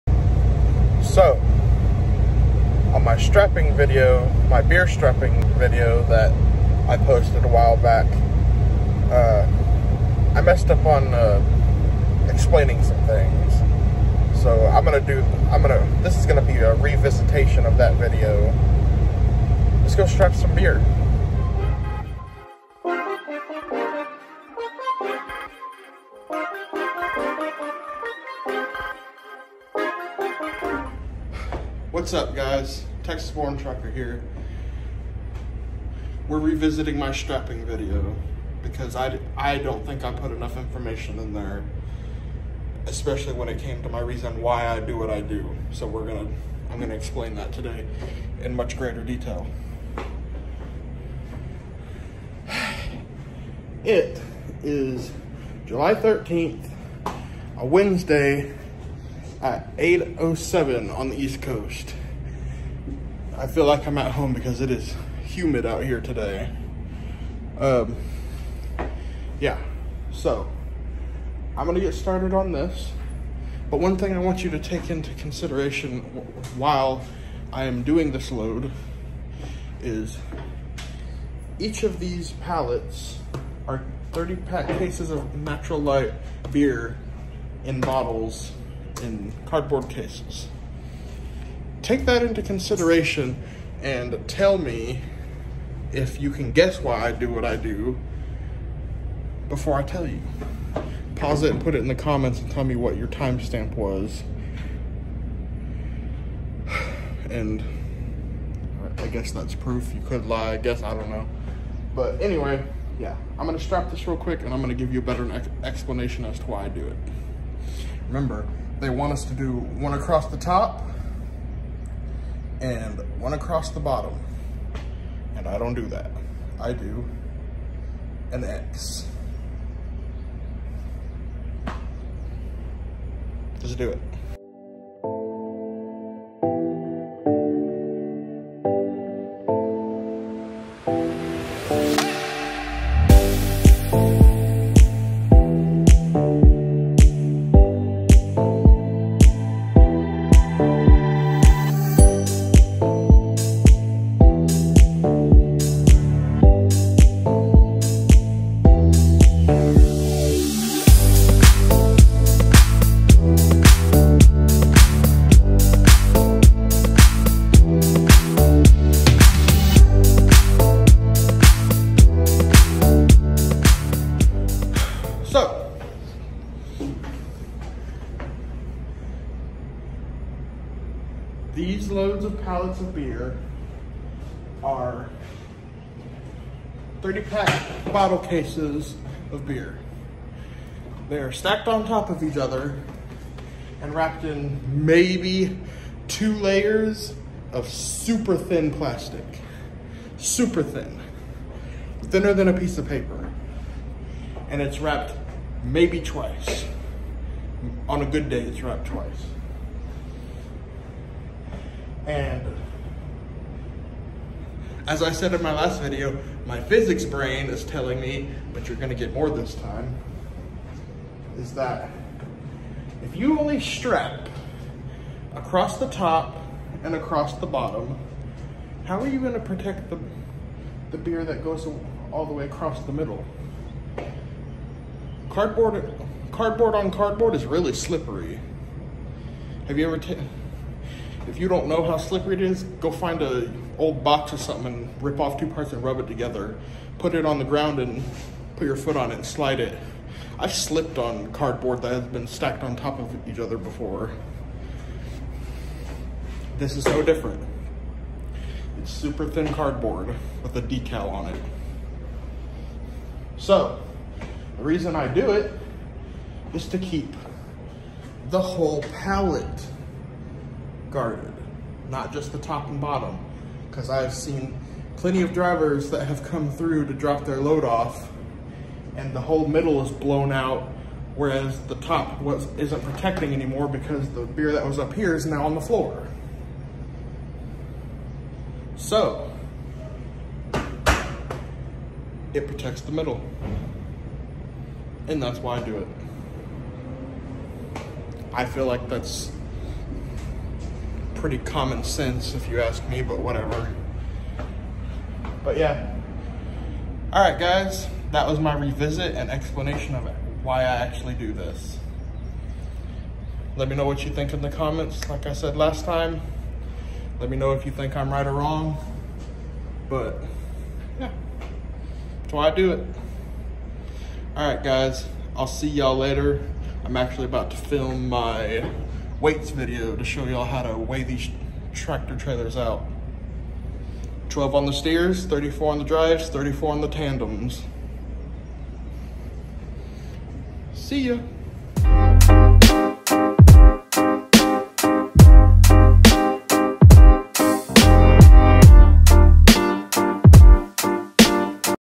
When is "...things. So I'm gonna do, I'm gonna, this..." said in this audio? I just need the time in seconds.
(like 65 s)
13 s.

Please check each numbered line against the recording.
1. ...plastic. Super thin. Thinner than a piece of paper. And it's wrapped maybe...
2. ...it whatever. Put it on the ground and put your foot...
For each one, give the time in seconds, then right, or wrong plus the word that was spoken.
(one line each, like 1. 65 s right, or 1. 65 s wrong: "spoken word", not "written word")
1. 198 s right
2. 246 s wrong: "together", not "whatever".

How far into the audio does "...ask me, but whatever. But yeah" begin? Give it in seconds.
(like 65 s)
302 s.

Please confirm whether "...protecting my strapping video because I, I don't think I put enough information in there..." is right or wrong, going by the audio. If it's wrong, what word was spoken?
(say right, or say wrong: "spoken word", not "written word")
wrong: "revisiting", not "protecting".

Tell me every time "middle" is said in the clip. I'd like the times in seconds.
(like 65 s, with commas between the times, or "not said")
232 s, 279 s, 292 s.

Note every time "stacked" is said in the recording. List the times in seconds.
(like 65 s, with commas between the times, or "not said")
191 s, 252 s.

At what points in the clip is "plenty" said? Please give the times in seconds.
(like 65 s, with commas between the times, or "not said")
274 s.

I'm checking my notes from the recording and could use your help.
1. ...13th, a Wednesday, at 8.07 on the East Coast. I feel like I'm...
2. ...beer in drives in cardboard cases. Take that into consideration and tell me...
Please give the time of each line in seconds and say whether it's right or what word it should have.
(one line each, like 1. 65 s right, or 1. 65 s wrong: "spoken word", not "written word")
1. 55 s right
2. 86 s wrong: "bottles", not "drives".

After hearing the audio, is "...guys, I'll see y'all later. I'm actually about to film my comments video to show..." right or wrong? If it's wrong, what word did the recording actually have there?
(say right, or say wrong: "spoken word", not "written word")
wrong: "weights", not "comments".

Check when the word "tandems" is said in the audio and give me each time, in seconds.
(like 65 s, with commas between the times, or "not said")
336 s.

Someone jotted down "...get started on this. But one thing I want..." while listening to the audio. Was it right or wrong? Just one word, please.
right.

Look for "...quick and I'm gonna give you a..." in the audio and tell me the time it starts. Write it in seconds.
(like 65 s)
114 s.